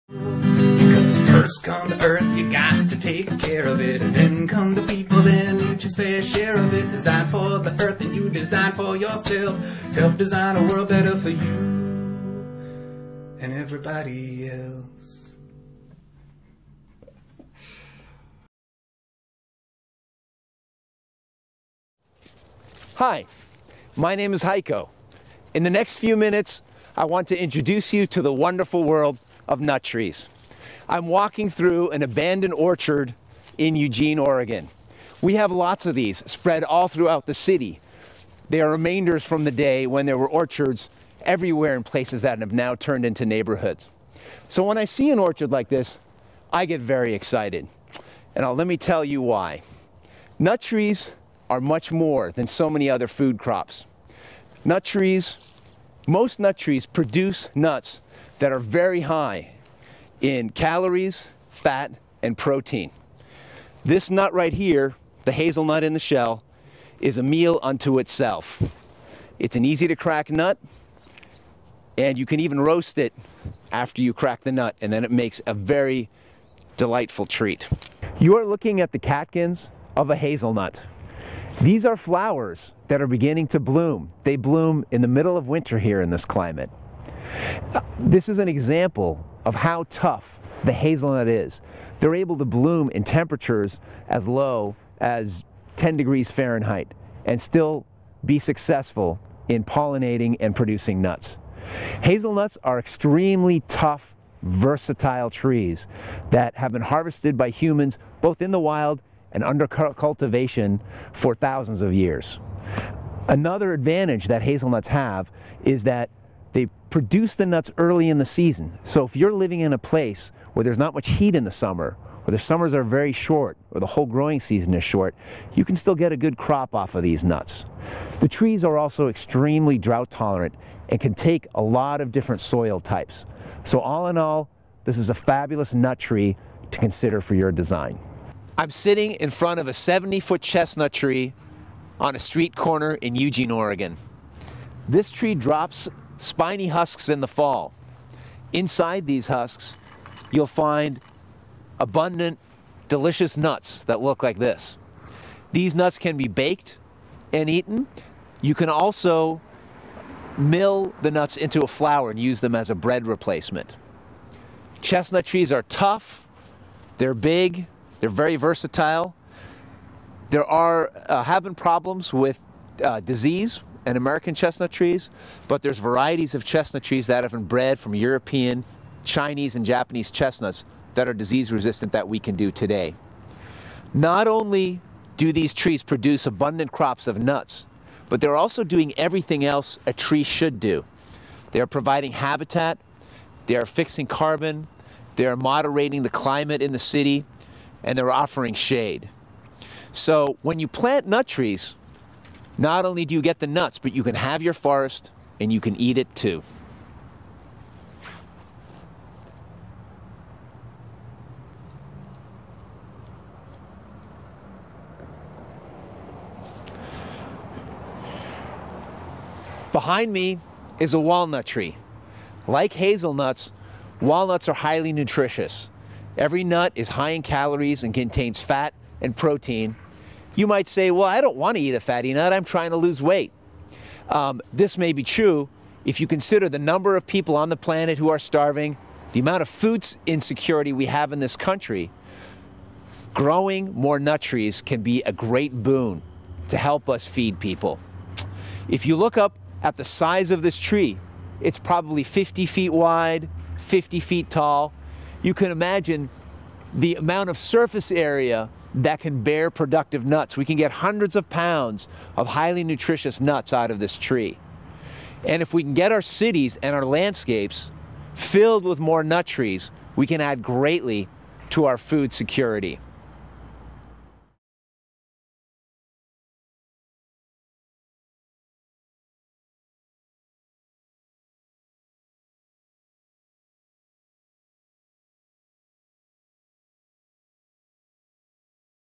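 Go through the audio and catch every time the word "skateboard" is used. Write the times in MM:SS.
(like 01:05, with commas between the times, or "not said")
not said.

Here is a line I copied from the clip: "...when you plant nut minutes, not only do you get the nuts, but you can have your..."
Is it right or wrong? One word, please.
wrong.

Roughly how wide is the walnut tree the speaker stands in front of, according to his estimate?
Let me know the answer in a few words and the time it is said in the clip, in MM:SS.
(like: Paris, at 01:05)
50 feet, at 04:12.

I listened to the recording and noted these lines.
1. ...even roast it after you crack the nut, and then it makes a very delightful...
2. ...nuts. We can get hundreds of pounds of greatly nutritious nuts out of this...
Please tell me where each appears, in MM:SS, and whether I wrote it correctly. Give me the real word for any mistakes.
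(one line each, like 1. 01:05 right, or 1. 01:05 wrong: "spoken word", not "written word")
1. 01:12 right
2. 04:20 wrong: "highly", not "greatly".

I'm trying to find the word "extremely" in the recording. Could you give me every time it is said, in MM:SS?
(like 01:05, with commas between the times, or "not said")
01:42, 02:09.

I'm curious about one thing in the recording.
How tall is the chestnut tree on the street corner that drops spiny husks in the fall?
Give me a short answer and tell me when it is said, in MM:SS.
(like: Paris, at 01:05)
70 feet, at 02:19.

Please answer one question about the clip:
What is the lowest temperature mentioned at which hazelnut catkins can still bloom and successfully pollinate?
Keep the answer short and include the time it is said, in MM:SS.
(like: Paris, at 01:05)
10 degrees Fahrenheit, at 01:35.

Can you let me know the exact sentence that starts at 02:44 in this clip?
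Chestnut trees are tough, they're big, they're very versatile.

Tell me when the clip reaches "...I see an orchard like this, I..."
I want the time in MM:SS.
00:44.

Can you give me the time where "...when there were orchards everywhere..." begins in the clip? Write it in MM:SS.
00:39.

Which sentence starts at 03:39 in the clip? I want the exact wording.
Behind me is a walnut tree.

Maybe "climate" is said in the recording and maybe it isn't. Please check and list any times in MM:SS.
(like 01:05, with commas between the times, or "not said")
01:26, 03:16.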